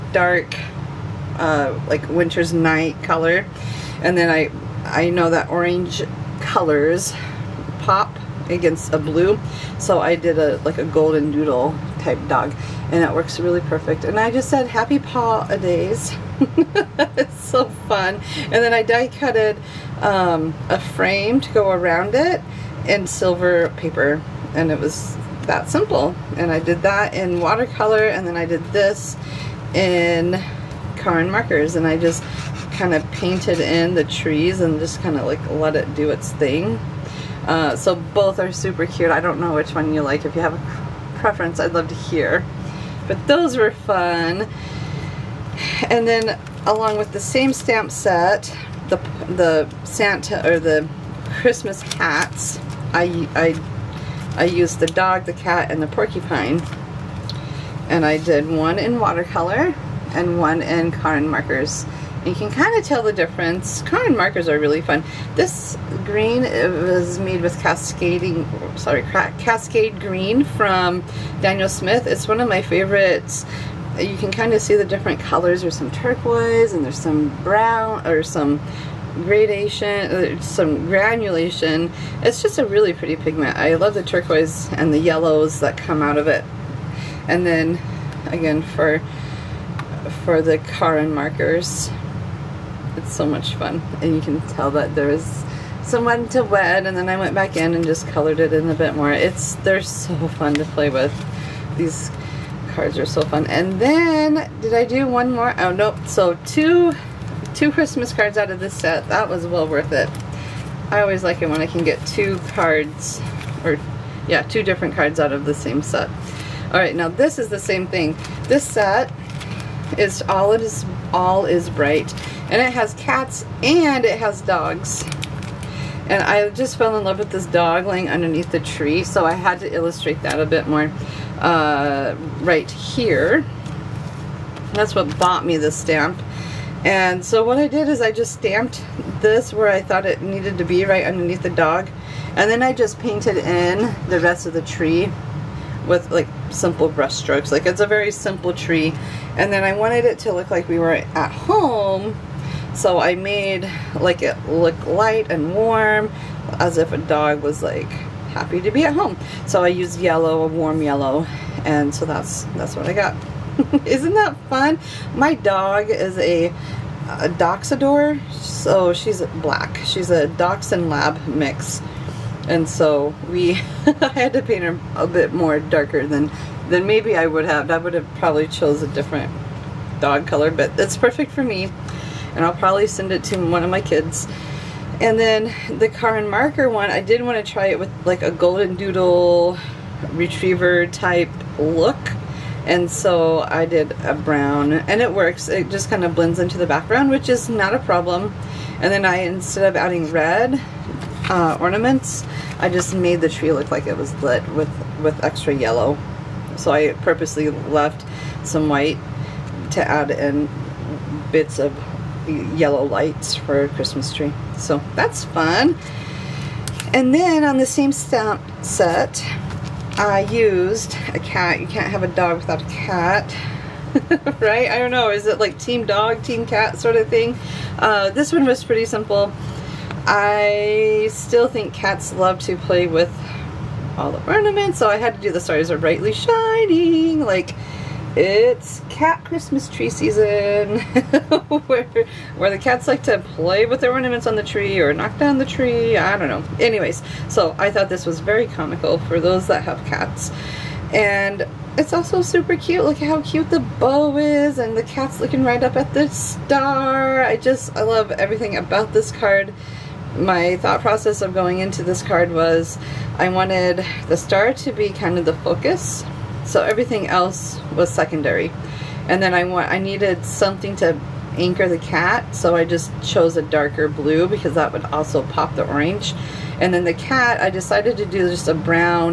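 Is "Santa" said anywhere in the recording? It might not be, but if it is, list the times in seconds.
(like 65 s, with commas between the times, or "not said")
49 s.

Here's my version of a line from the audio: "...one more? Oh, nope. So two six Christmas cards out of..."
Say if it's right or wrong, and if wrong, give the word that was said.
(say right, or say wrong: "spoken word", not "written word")
wrong: "two", not "six".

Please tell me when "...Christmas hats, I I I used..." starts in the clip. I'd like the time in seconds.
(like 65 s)
51 s.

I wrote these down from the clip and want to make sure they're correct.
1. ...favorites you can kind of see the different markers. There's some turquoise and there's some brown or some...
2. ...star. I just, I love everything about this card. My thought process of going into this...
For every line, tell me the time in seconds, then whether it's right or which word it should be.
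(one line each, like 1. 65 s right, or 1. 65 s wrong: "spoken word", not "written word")
1. 72 s wrong: "colors", not "markers"
2. 256 s right.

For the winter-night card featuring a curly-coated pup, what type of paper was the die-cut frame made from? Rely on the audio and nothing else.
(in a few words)
Silver paper.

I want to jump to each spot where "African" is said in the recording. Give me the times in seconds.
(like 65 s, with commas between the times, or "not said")
not said.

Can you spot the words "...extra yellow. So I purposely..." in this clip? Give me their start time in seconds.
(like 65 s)
205 s.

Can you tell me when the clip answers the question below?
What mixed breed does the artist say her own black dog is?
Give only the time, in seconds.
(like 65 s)
167 s.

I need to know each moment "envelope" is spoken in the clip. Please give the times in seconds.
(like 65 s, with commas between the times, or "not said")
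not said.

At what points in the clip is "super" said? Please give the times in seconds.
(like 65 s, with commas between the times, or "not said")
38 s, 252 s.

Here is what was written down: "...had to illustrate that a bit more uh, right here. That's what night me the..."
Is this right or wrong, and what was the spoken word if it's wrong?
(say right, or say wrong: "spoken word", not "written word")
wrong: "bought", not "night".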